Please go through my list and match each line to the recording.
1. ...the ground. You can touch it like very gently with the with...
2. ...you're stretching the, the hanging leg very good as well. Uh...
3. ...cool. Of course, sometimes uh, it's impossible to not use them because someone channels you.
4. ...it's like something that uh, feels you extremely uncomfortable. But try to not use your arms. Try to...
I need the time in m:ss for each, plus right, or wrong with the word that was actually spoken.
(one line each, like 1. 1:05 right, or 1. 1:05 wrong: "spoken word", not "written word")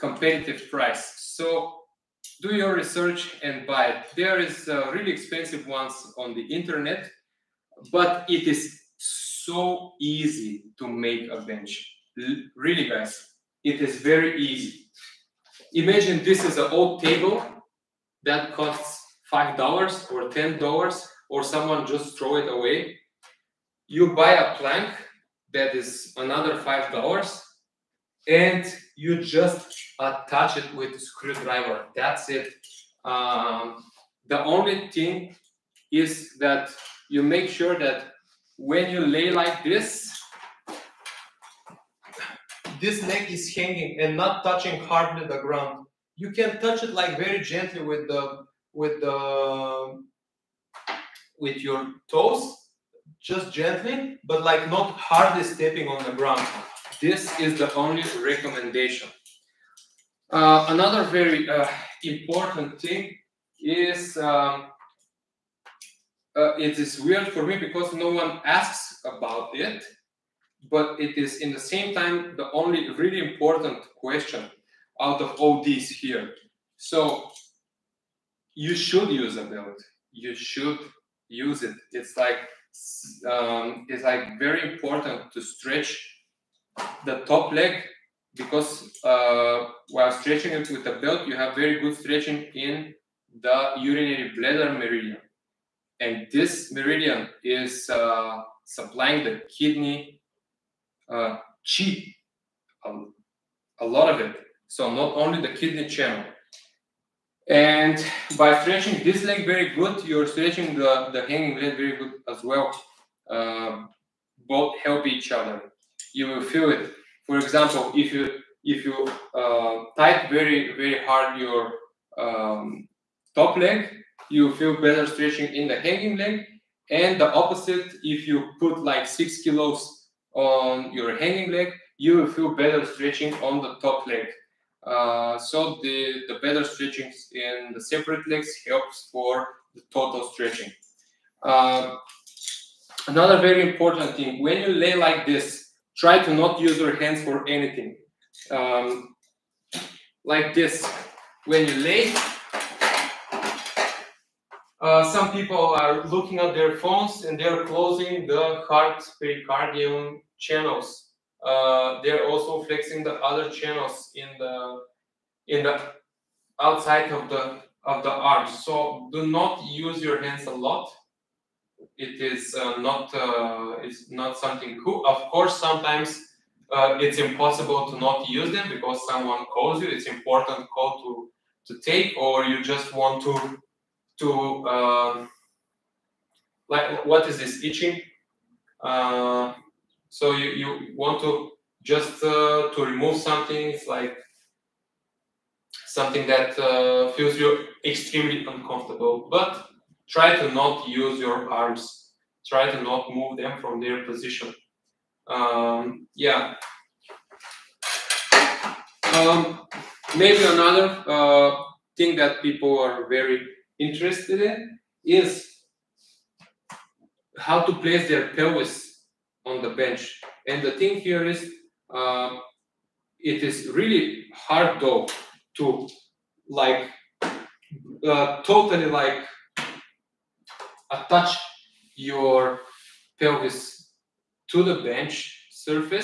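1. 0:45 right
2. 1:50 right
3. 2:54 wrong: "calls", not "channels"
4. 3:13 right.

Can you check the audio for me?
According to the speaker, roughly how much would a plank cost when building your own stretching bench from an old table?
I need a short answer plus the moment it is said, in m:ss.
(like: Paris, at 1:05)
$5, at 0:26.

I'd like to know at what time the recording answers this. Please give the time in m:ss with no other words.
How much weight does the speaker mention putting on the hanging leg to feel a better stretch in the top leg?
2:09.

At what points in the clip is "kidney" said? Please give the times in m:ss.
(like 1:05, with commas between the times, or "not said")
1:39, 1:45.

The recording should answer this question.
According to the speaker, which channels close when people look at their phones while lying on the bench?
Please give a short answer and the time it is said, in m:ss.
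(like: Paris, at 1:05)
heart pericardium channels, at 2:38.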